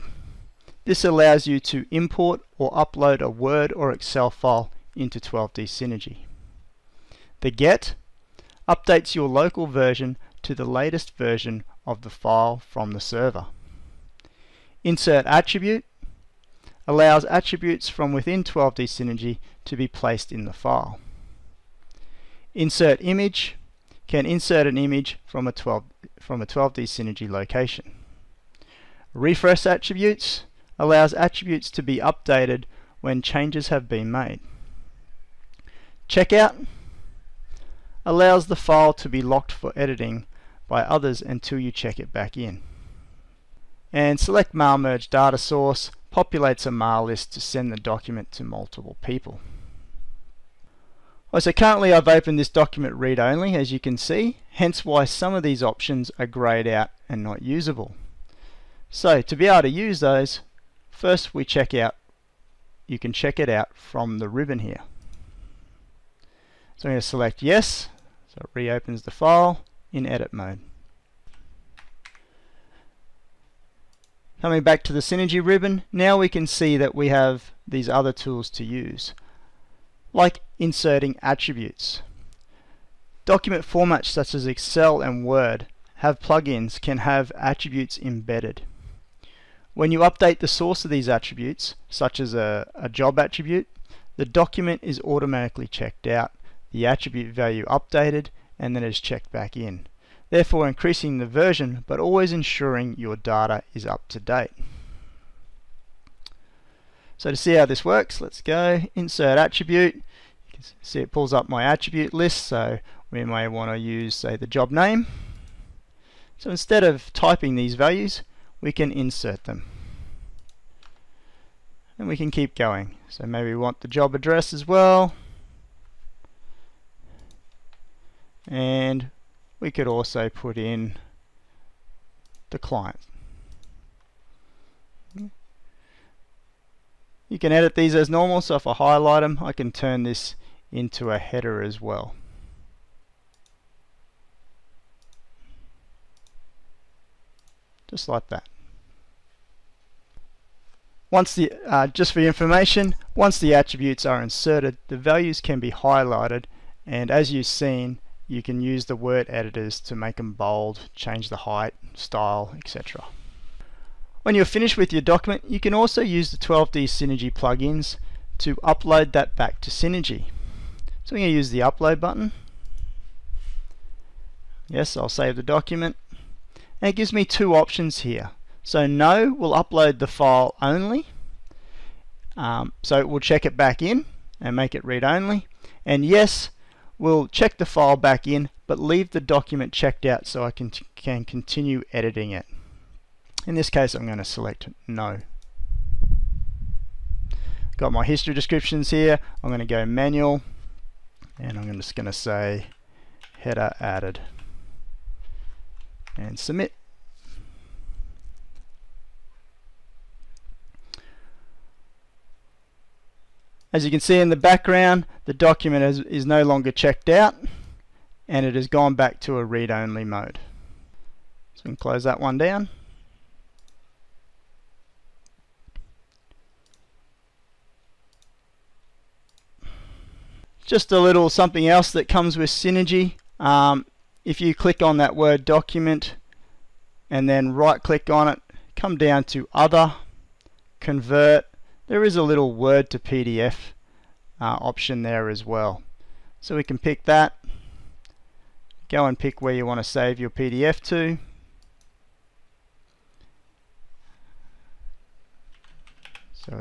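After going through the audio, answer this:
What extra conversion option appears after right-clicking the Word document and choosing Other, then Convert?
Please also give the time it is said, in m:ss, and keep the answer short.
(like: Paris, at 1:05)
Word to PDF, at 4:02.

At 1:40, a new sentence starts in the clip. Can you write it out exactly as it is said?
Therefore increasing the version, but always ensuring your data is up to date.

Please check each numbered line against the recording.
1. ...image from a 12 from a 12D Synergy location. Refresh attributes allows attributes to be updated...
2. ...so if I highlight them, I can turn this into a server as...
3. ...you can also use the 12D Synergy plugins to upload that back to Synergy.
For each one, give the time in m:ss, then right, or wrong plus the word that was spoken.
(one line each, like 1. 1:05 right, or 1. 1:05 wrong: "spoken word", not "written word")
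1. 0:24 right
2. 2:18 wrong: "header", not "server"
3. 2:45 right.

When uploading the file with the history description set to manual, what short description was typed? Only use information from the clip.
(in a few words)
Header added.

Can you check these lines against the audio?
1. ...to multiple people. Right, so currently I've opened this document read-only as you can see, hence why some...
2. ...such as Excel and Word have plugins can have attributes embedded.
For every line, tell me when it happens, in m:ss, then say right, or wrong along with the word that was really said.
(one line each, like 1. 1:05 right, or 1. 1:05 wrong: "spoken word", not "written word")
1. 0:48 right
2. 1:24 right.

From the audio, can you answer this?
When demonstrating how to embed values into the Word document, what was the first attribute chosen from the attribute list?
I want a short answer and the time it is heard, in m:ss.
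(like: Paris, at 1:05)
Job name, at 1:54.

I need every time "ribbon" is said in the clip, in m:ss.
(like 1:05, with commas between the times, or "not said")
1:04, 1:15.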